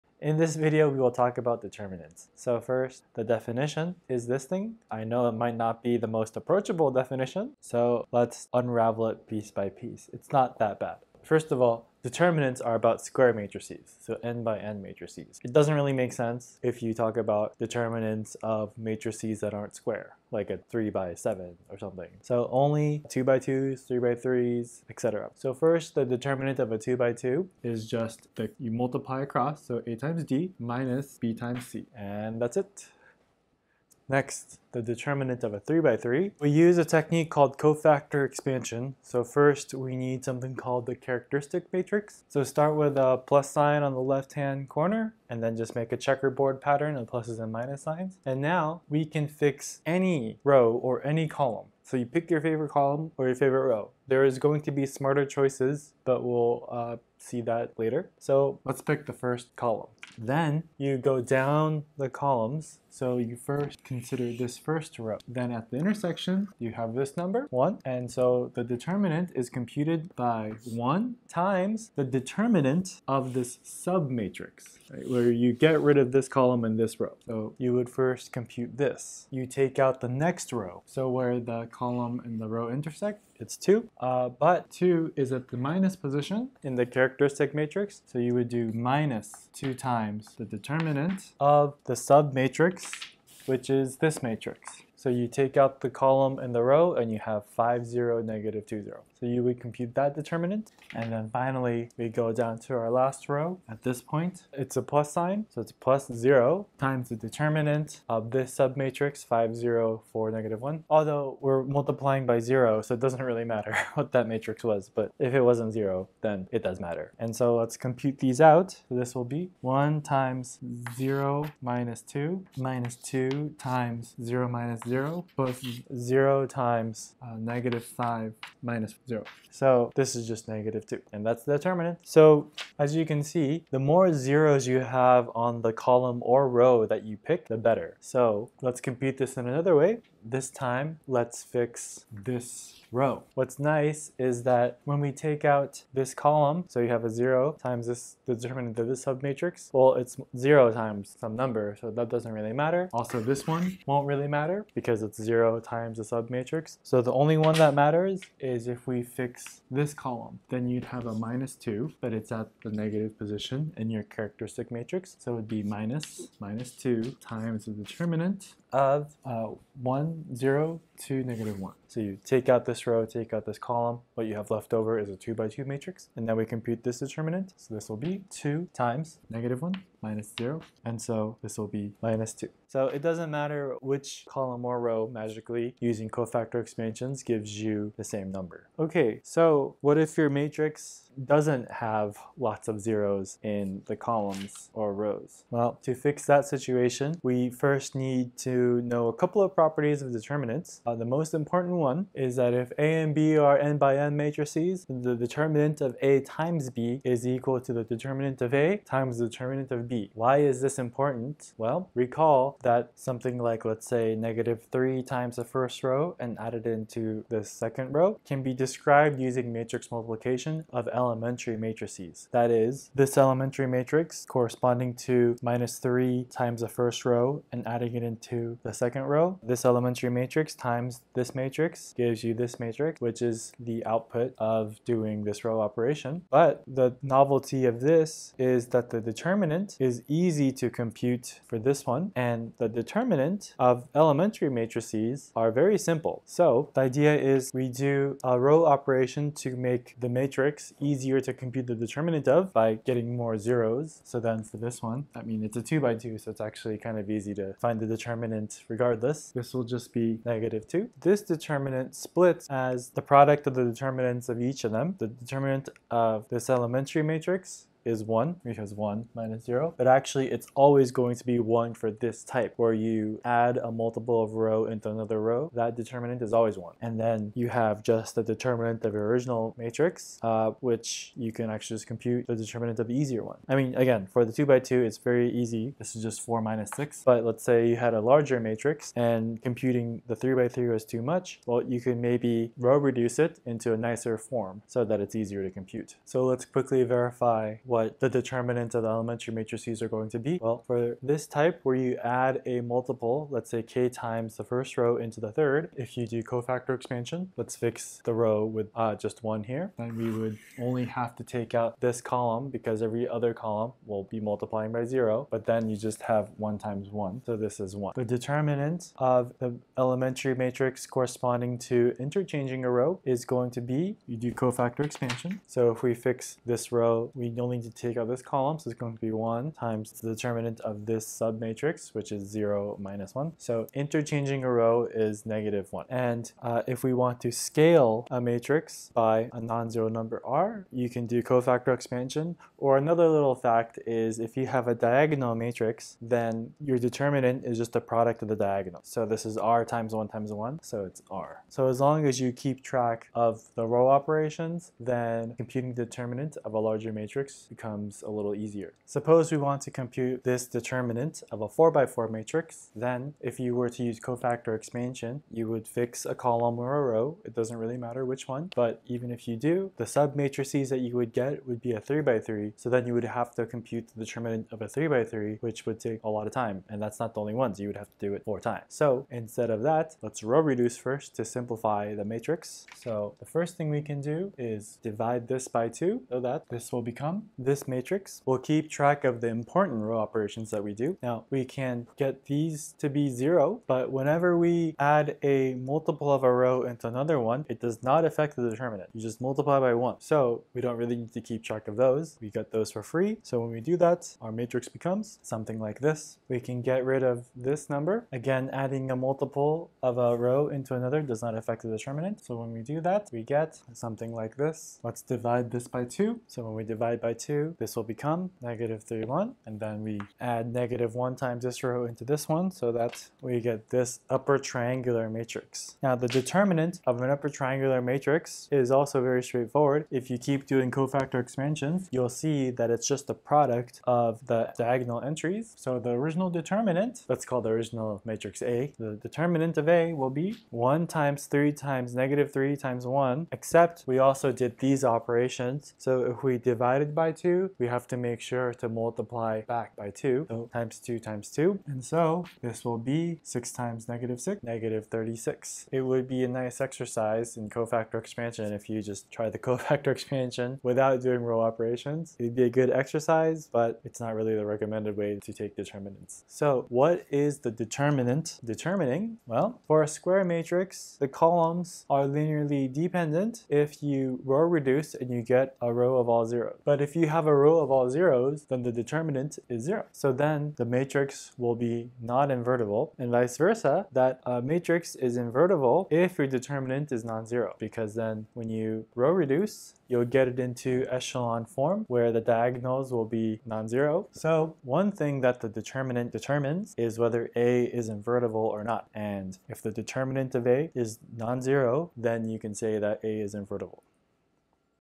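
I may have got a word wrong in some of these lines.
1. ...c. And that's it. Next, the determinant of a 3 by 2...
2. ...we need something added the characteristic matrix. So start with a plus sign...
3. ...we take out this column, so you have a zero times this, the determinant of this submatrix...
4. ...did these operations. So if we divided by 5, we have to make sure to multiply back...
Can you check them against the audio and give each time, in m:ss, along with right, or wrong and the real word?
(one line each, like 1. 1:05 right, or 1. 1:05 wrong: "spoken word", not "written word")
1. 0:31 wrong: "3", not "2"
2. 0:39 wrong: "called", not "added"
3. 2:24 right
4. 7:24 wrong: "2", not "5".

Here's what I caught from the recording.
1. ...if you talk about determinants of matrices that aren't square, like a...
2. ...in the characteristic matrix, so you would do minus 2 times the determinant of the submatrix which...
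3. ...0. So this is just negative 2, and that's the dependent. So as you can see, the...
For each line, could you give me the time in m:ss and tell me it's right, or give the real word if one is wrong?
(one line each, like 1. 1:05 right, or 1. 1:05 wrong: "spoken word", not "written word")
1. 0:16 right
2. 1:26 right
3. 2:09 wrong: "determinant", not "dependent".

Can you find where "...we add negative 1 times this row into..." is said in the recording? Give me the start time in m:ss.
6:59.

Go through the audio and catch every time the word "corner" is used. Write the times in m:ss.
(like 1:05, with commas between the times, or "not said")
0:44.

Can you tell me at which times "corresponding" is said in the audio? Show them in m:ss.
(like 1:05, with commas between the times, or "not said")
3:44, 5:20.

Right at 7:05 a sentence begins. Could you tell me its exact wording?
Now the determinant of an upper triangular matrix is also very straightforward.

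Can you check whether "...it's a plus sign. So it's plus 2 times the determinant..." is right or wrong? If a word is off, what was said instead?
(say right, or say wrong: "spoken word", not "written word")
wrong: "0", not "2".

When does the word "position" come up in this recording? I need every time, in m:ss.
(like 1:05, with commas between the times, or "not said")
1:25, 2:43.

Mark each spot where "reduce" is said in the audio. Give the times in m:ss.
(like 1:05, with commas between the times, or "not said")
4:52, 6:20, 7:54, 8:09.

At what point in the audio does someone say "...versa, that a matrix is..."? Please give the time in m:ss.
8:03.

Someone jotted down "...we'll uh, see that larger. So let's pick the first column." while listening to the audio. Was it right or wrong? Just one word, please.
wrong.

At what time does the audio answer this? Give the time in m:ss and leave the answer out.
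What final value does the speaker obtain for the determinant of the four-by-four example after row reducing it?
7:34.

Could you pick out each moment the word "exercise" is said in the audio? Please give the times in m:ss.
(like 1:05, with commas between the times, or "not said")
7:36, 7:42.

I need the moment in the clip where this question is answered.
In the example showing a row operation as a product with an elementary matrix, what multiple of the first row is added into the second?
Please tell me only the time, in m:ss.
3:34.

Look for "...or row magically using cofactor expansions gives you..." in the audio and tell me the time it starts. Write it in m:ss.
3:04.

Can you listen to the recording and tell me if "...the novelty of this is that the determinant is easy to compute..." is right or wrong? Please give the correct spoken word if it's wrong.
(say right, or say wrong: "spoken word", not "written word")
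right.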